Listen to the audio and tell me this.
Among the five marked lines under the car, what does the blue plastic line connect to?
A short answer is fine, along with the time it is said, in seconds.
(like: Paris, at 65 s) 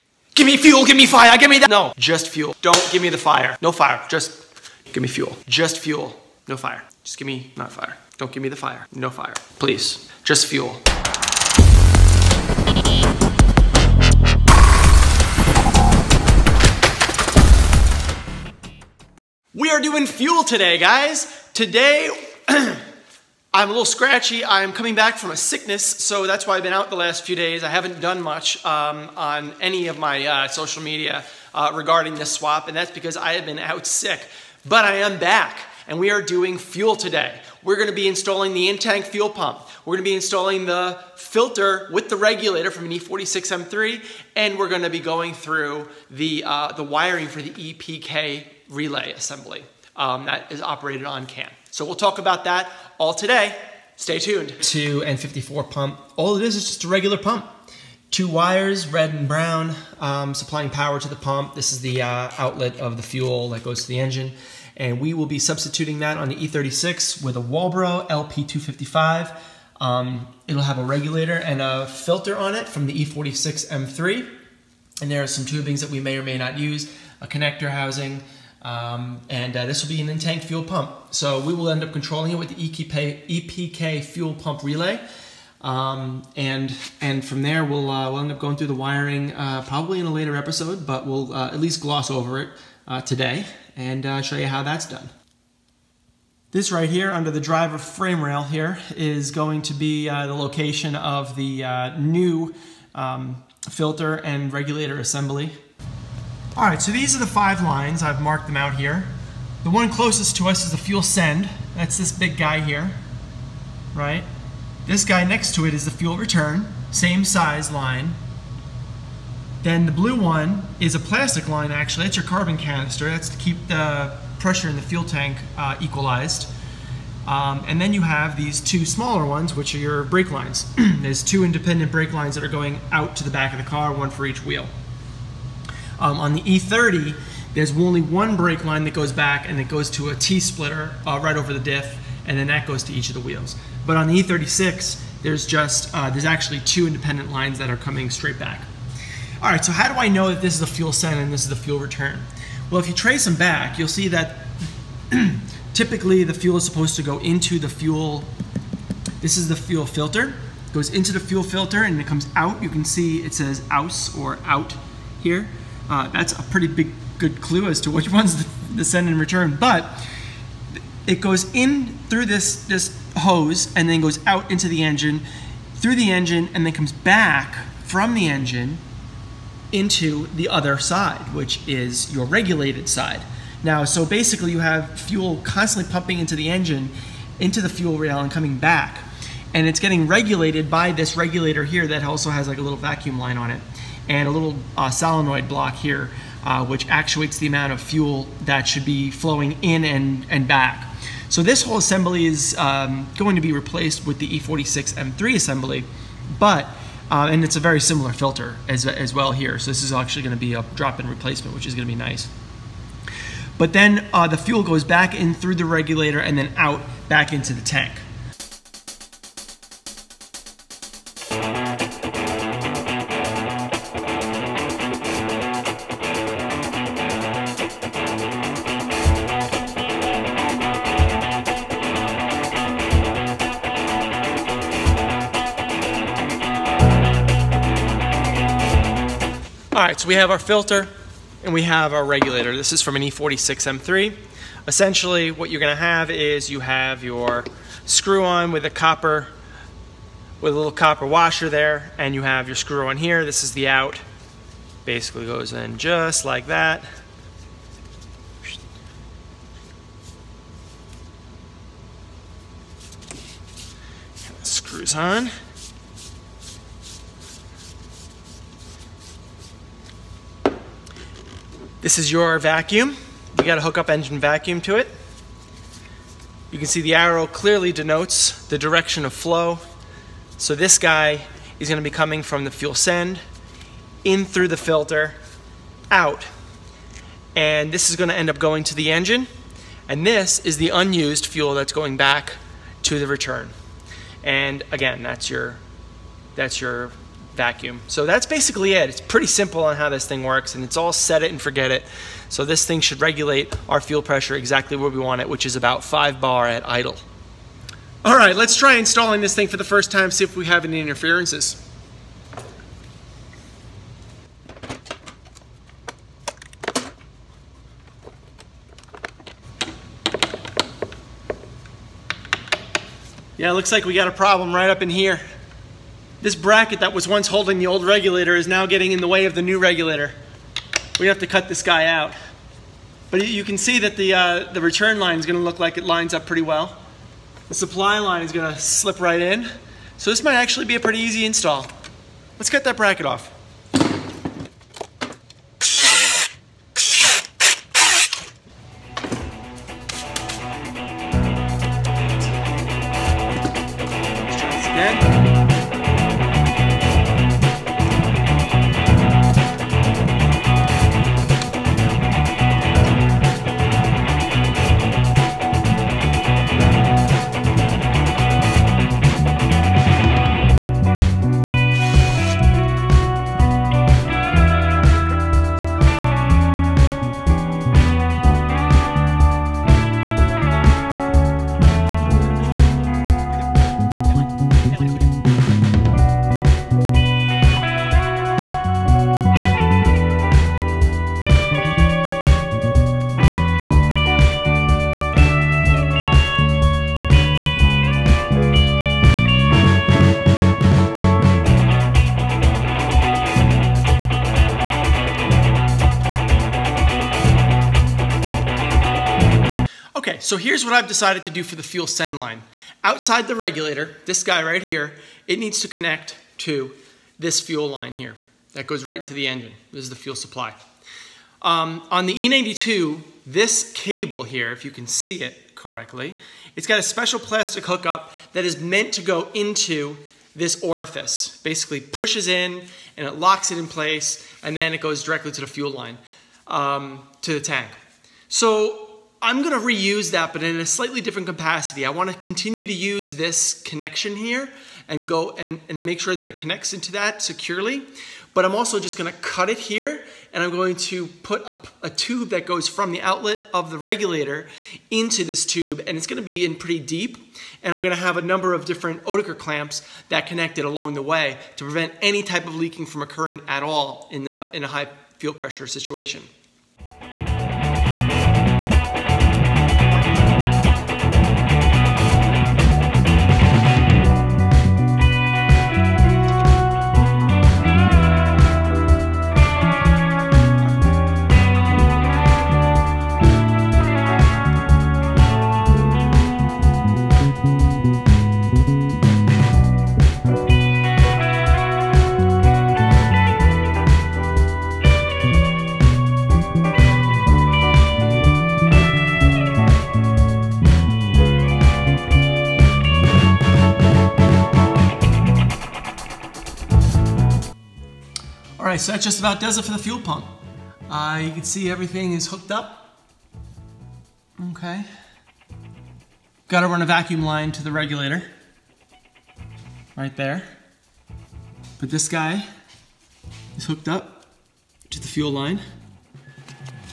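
Carbon canister, at 122 s.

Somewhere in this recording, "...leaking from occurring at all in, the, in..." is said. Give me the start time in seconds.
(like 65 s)
462 s.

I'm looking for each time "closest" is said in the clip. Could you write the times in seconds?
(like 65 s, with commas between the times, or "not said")
109 s.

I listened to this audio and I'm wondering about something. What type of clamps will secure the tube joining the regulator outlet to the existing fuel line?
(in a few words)
Oetiker clamps.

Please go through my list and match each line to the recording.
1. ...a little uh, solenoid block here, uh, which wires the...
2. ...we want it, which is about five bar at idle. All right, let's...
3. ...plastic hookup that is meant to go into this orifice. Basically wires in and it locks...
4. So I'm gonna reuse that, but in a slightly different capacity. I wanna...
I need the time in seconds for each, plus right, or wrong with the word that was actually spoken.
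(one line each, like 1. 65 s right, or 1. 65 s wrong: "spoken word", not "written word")
1. 194 s wrong: "actuates", not "wires"
2. 304 s right
3. 427 s wrong: "pushes", not "wires"
4. 438 s right.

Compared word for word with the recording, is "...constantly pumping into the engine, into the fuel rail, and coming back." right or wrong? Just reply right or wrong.
right.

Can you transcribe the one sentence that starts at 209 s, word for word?
So this is actually going to be a drop-in replacement, which is going to be nice.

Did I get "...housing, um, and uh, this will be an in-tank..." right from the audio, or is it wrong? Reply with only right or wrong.
right.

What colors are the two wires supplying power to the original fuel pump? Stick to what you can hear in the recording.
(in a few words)
Red and brown.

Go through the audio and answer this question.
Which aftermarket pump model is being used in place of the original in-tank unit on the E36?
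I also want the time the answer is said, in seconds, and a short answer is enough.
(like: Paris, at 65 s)
Walbro LP255, at 67 s.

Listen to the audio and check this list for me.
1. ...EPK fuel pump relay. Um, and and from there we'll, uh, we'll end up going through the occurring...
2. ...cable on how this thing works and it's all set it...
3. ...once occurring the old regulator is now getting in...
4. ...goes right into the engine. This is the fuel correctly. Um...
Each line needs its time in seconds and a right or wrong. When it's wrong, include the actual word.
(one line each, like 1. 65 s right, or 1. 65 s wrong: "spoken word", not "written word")
1. 83 s wrong: "wiring", not "occurring"
2. 299 s wrong: "simple", not "cable"
3. 327 s wrong: "holding", not "occurring"
4. 418 s wrong: "supply", not "correctly".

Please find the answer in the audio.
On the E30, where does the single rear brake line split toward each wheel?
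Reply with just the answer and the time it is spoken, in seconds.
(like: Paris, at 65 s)
Over the diff, at 141 s.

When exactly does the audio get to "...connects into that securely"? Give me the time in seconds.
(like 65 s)
446 s.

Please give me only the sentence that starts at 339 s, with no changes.
So this might actually be a pretty easy install.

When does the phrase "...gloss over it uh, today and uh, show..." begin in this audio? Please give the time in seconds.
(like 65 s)
91 s.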